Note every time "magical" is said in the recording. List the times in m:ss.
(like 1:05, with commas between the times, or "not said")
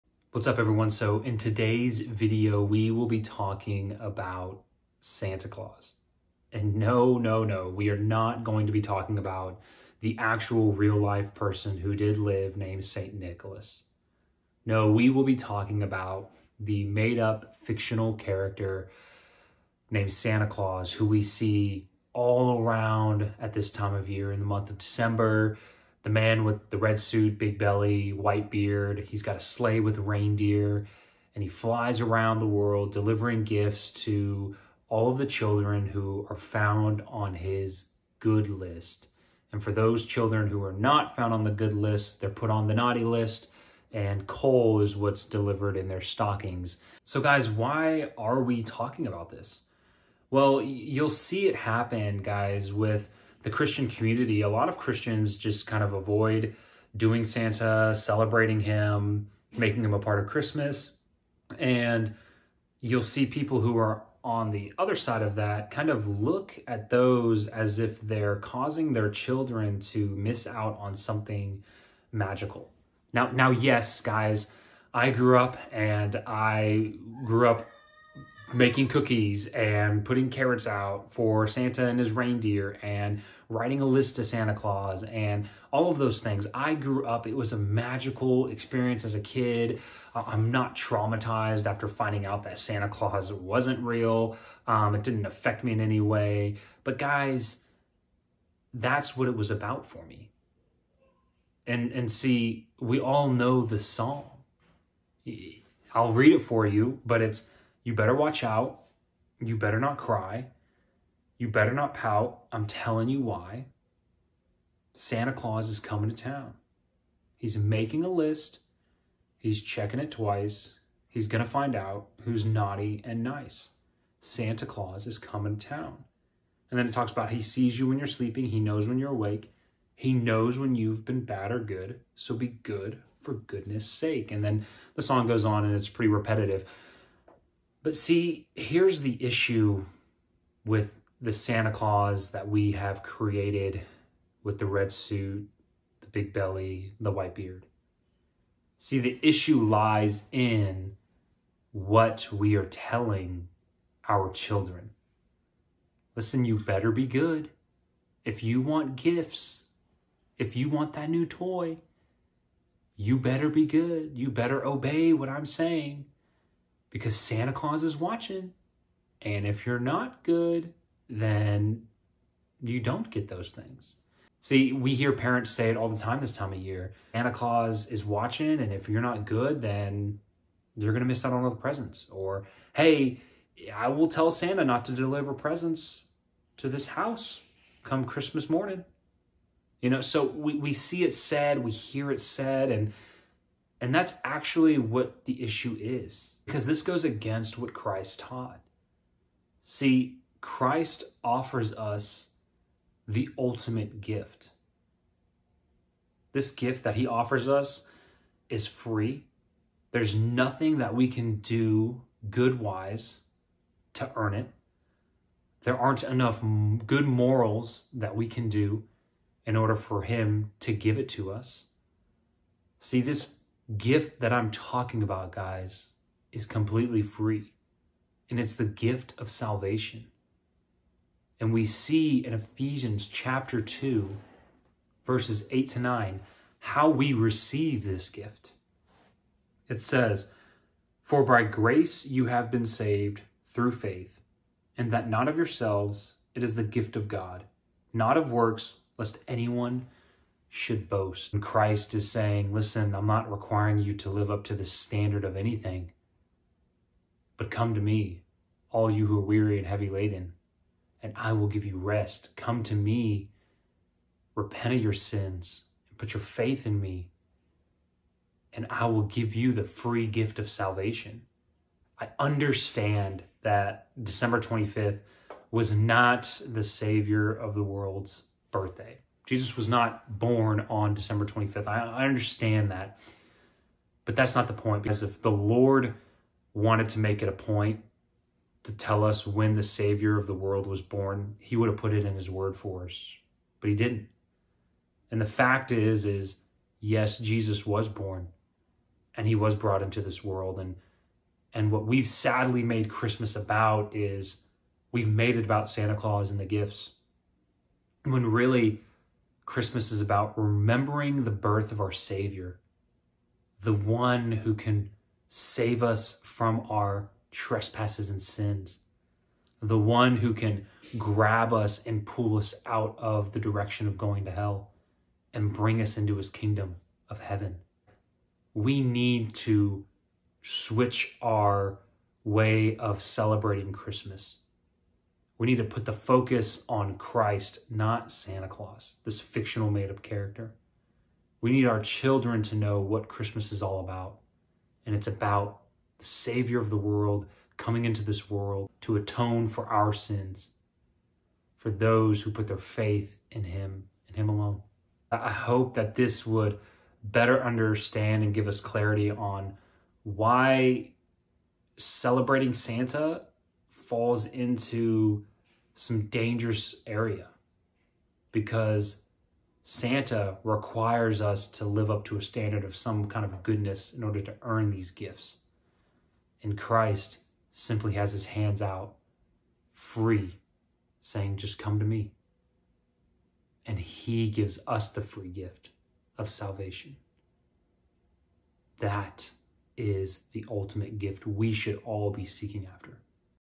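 1:12, 1:27.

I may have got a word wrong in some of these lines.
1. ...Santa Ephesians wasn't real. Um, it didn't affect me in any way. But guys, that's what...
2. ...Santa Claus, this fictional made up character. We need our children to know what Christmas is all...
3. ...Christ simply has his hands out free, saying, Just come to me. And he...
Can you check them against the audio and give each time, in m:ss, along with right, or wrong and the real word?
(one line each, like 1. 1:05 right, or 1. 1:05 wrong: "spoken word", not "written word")
1. 1:32 wrong: "Claus", not "Ephesians"
2. 5:38 right
3. 6:16 right.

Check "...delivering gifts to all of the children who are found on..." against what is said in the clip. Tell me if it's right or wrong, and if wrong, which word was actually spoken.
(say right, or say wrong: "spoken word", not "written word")
right.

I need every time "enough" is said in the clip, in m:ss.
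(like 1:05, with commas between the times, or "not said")
3:36.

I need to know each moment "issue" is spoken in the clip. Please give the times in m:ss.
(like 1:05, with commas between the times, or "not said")
2:19, 2:29, 3:15.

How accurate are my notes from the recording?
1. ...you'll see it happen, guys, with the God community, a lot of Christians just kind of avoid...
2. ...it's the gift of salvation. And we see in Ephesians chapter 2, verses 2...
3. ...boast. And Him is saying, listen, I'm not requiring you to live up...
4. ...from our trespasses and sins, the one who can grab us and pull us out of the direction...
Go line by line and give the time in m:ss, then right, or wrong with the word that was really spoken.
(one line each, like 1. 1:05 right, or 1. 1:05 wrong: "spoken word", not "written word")
1. 0:50 wrong: "Christian", not "God"
2. 3:48 wrong: "8", not "2"
3. 4:10 wrong: "Christ", not "Him"
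4. 5:16 right.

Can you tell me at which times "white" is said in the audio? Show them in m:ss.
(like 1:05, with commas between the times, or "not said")
0:28, 2:27.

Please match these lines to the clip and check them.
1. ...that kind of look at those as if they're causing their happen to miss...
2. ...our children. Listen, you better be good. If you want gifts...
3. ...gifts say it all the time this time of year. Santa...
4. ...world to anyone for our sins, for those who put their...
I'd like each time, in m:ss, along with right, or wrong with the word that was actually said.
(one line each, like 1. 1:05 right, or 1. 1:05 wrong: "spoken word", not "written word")
1. 1:05 wrong: "children", not "happen"
2. 2:34 right
3. 2:55 wrong: "parents", not "gifts"
4. 5:48 wrong: "atone", not "anyone".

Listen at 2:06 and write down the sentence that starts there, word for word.
And then it talks about he sees you when you're sleeping.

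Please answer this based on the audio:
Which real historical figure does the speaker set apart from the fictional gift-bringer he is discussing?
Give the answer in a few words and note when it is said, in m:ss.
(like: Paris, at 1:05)
St. Nicholas, at 0:12.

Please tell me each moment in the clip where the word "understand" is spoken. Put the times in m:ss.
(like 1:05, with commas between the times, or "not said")
4:32, 4:42, 5:57.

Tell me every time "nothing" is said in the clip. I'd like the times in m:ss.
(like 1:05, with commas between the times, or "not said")
3:30.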